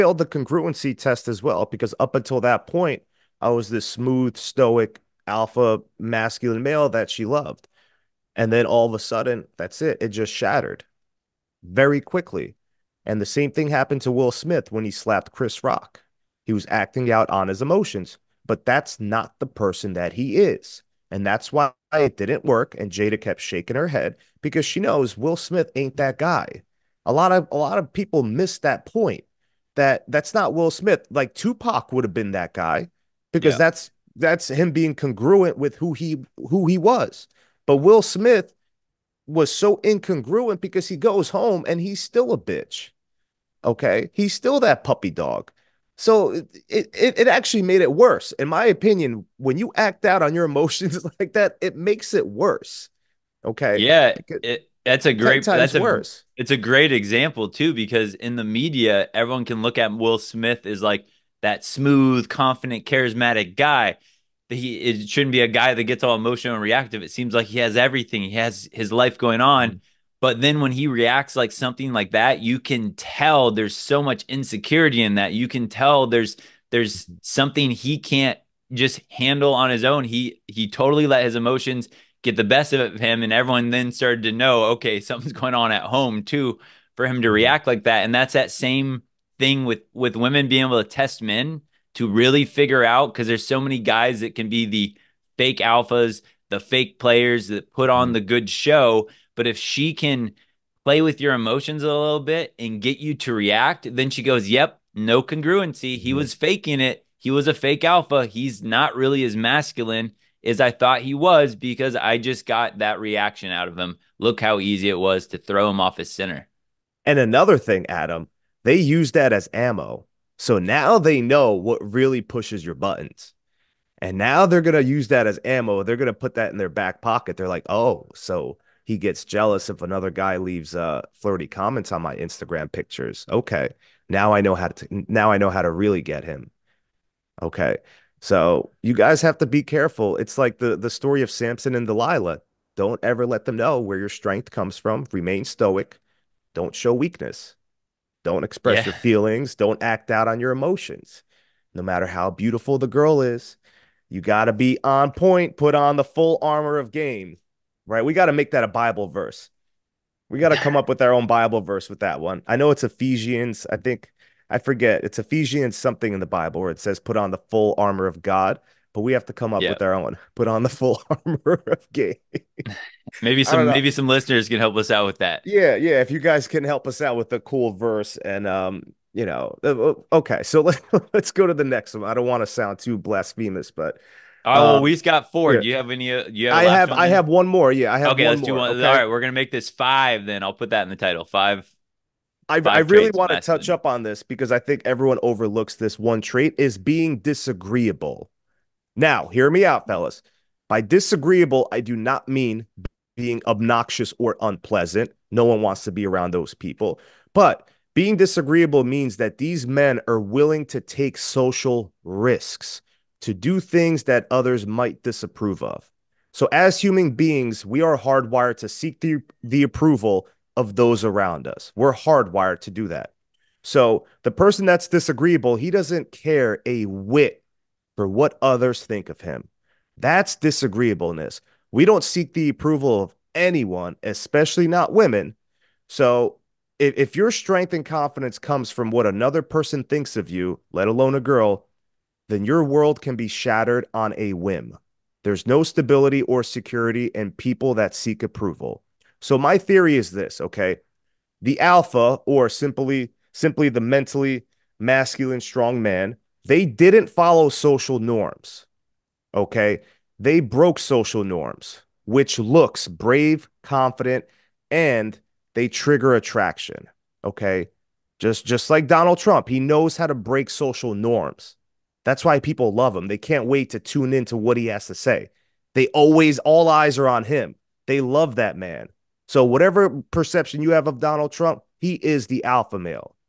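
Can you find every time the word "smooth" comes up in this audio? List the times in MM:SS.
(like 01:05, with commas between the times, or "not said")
00:03, 01:01.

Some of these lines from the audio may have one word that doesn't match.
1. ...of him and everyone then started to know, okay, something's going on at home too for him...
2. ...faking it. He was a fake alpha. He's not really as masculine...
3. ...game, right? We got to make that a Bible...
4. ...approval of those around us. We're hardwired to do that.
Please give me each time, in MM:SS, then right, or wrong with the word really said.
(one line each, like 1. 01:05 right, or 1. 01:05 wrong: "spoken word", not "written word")
1. 01:22 right
2. 01:46 right
3. 02:36 right
4. 03:39 right.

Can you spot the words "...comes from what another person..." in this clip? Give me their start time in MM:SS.
03:58.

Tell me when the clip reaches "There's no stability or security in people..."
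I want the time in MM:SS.
04:05.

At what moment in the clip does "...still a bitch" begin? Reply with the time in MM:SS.
00:42.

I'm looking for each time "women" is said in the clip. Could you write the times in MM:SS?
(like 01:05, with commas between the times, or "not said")
01:30, 03:54.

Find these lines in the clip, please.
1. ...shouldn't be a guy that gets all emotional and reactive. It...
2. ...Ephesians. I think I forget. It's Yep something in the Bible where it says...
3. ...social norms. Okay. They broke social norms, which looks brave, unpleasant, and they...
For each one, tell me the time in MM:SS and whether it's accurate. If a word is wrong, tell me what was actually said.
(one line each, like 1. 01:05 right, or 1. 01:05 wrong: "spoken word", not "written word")
1. 01:05 right
2. 02:42 wrong: "Ephesians", not "Yep"
3. 04:17 wrong: "confident", not "unpleasant".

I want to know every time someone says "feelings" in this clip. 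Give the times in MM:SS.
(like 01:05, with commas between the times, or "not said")
02:28.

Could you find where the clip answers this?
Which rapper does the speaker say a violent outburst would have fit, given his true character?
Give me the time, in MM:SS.
00:31.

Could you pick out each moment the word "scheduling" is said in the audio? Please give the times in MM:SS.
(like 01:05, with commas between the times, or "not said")
not said.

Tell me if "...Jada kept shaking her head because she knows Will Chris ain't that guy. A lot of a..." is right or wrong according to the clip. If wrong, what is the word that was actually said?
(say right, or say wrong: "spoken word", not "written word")
wrong: "Smith", not "Chris".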